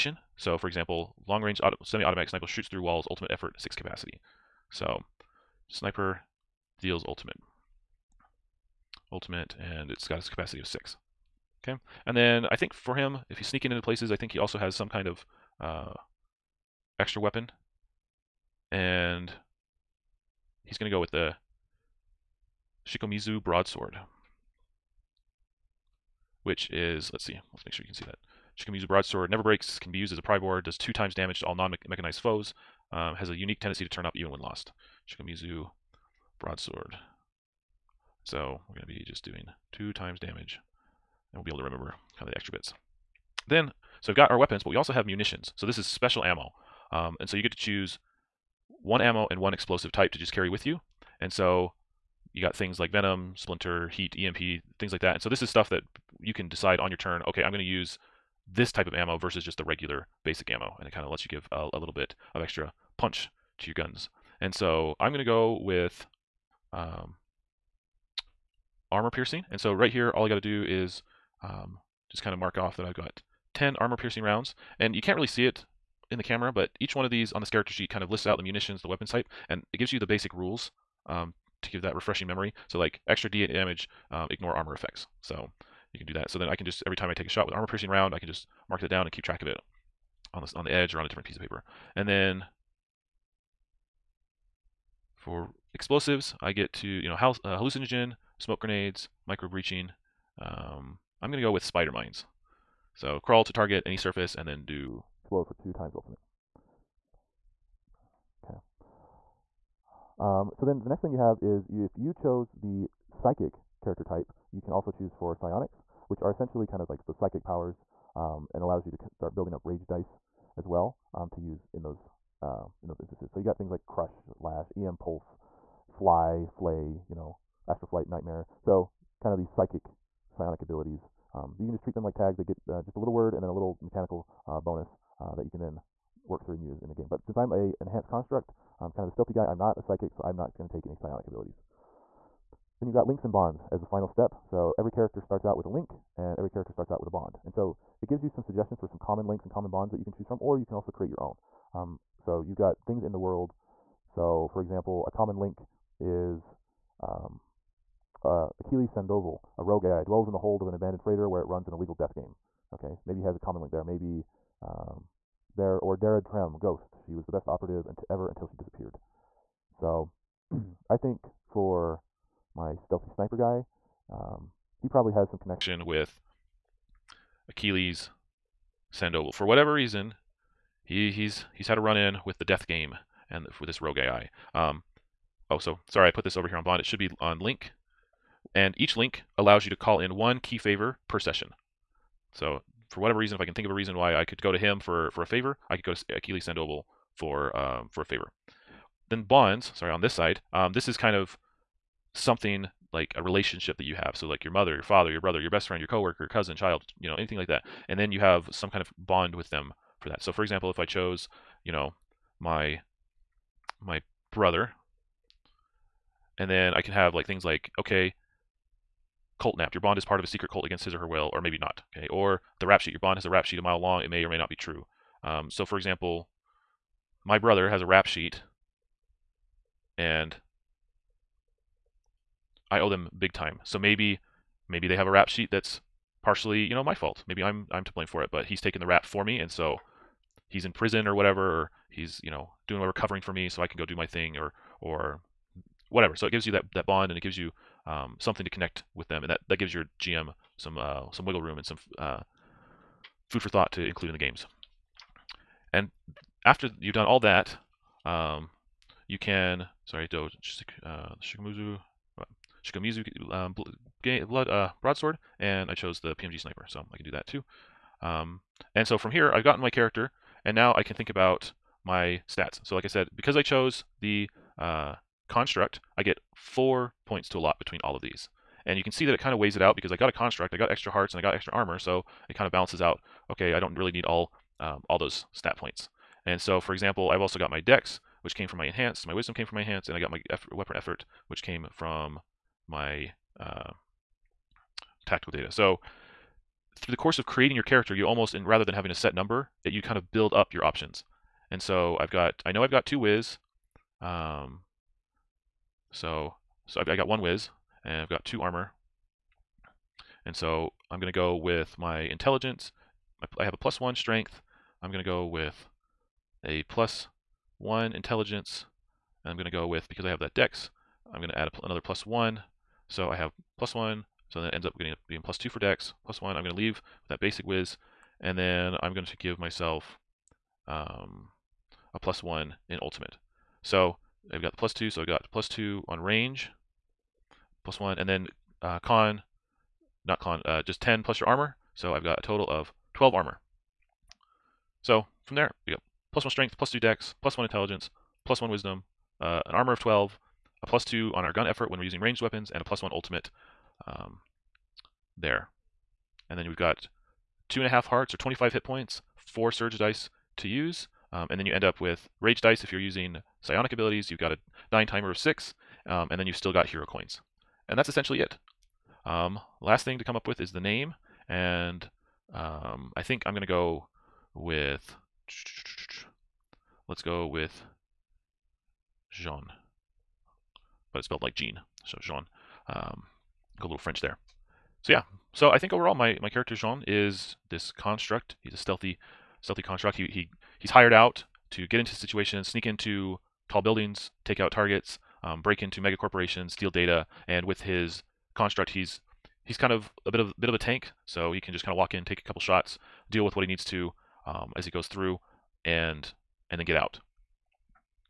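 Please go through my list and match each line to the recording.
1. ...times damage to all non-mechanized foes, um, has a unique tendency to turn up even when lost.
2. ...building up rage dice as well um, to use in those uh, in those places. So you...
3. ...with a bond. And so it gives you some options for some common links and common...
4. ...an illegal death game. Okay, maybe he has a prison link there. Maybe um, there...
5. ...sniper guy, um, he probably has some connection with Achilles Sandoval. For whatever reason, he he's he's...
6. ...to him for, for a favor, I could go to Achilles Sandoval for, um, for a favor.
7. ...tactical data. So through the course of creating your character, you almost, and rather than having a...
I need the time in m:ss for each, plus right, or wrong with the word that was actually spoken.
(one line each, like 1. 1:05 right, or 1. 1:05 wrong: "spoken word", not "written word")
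1. 0:30 right
2. 1:59 wrong: "instances", not "places"
3. 2:26 wrong: "suggestions", not "options"
4. 2:41 wrong: "common", not "prison"
5. 2:53 right
6. 3:14 right
7. 4:55 right.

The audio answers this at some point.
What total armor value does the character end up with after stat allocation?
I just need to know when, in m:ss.
5:42.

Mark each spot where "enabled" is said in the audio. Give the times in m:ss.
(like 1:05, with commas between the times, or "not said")
not said.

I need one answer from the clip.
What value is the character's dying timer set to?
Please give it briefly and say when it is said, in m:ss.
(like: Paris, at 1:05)
6, at 6:04.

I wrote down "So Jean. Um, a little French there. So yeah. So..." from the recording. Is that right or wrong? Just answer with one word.
right.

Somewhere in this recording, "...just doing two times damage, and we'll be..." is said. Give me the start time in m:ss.
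0:39.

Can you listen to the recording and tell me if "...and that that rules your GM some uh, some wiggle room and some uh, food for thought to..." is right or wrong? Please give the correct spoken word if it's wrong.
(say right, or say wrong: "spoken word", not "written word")
wrong: "gives", not "rules".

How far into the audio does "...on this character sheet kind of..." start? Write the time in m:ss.
1:17.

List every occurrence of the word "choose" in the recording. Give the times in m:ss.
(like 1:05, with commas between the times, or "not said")
0:47, 1:54, 2:30.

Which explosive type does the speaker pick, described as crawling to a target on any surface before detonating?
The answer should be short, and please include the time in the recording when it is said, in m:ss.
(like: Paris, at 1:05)
Spider mines, at 1:41.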